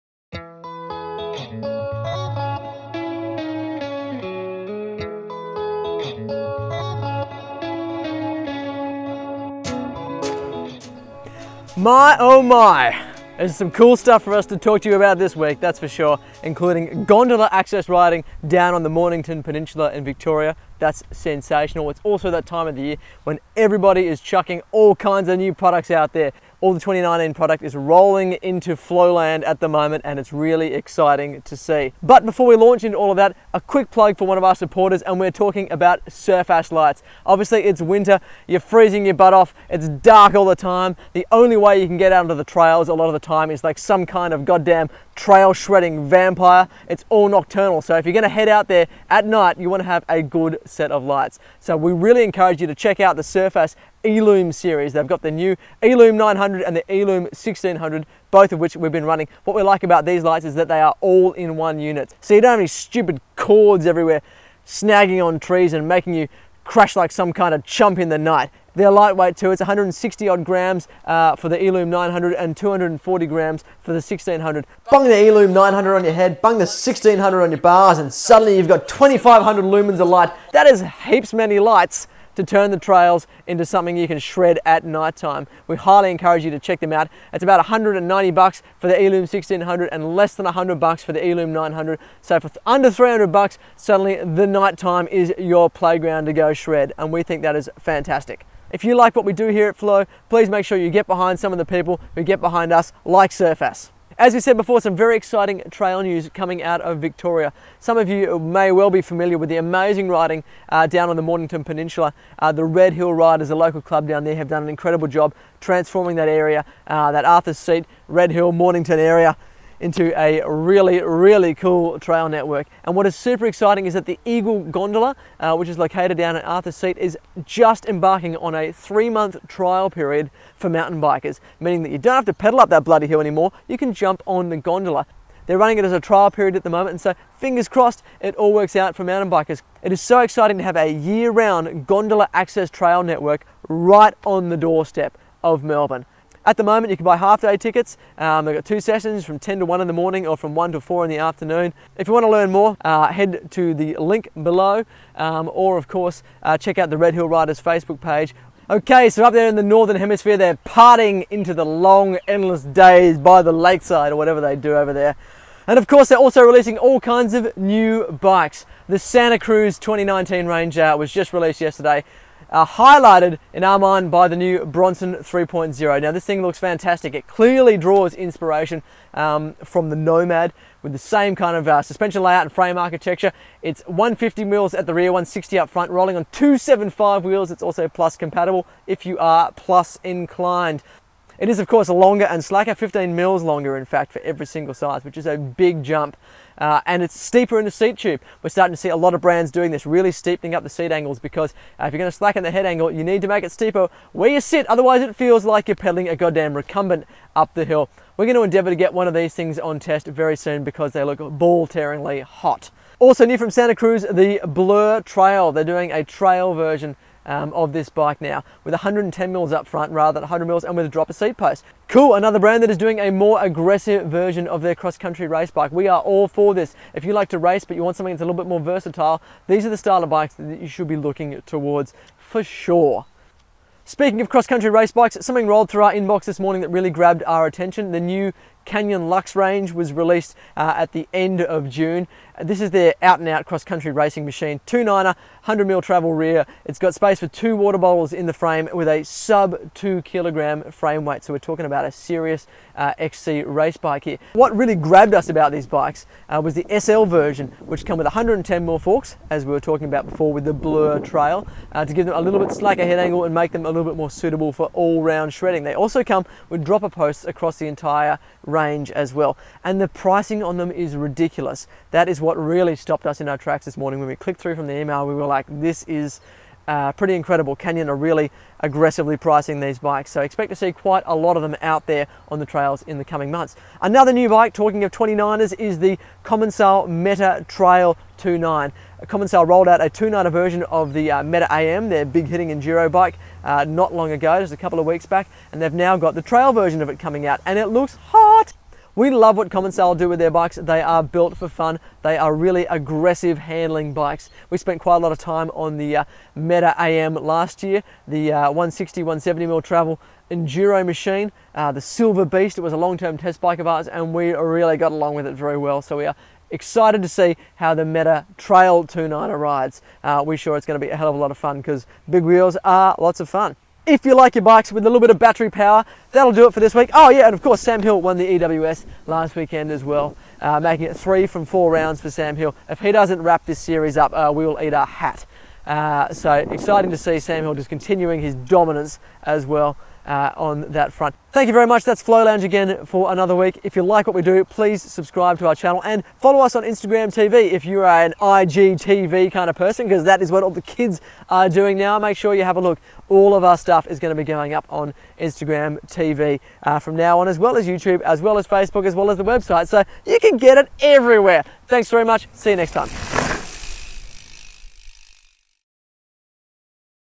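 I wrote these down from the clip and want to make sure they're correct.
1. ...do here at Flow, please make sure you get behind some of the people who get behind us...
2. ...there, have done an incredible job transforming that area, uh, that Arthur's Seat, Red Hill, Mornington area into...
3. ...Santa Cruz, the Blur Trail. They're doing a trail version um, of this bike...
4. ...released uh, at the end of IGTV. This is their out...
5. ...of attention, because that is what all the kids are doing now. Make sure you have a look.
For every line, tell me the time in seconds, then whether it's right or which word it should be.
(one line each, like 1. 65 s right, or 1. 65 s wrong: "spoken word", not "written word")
1. 99 s right
2. 114 s right
3. 213 s right
4. 239 s wrong: "June", not "IGTV"
5. 349 s wrong: "person", not "attention".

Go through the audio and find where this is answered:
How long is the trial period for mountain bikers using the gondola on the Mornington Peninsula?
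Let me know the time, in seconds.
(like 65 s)
128 s.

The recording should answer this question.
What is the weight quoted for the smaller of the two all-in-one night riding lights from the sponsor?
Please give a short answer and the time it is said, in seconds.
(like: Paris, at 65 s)
160 grams, at 69 s.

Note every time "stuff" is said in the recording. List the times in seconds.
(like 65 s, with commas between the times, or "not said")
13 s, 353 s.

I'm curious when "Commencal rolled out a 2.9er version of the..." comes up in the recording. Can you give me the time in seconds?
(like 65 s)
289 s.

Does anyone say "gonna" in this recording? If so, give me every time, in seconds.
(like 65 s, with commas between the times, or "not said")
48 s, 201 s, 208 s, 320 s.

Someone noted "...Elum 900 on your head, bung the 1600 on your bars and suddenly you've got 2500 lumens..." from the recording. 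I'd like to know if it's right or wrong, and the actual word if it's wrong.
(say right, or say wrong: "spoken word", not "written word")
right.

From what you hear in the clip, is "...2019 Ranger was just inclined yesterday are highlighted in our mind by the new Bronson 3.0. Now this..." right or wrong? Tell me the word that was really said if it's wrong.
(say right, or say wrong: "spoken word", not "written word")
wrong: "released", not "inclined".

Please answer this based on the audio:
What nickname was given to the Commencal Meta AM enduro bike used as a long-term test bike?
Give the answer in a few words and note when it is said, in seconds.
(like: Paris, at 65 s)
the Silver Beast, at 311 s.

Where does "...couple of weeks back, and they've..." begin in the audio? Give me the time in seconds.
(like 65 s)
294 s.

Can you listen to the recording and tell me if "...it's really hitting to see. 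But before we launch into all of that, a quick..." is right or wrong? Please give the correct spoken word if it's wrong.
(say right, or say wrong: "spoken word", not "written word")
wrong: "exciting", not "hitting".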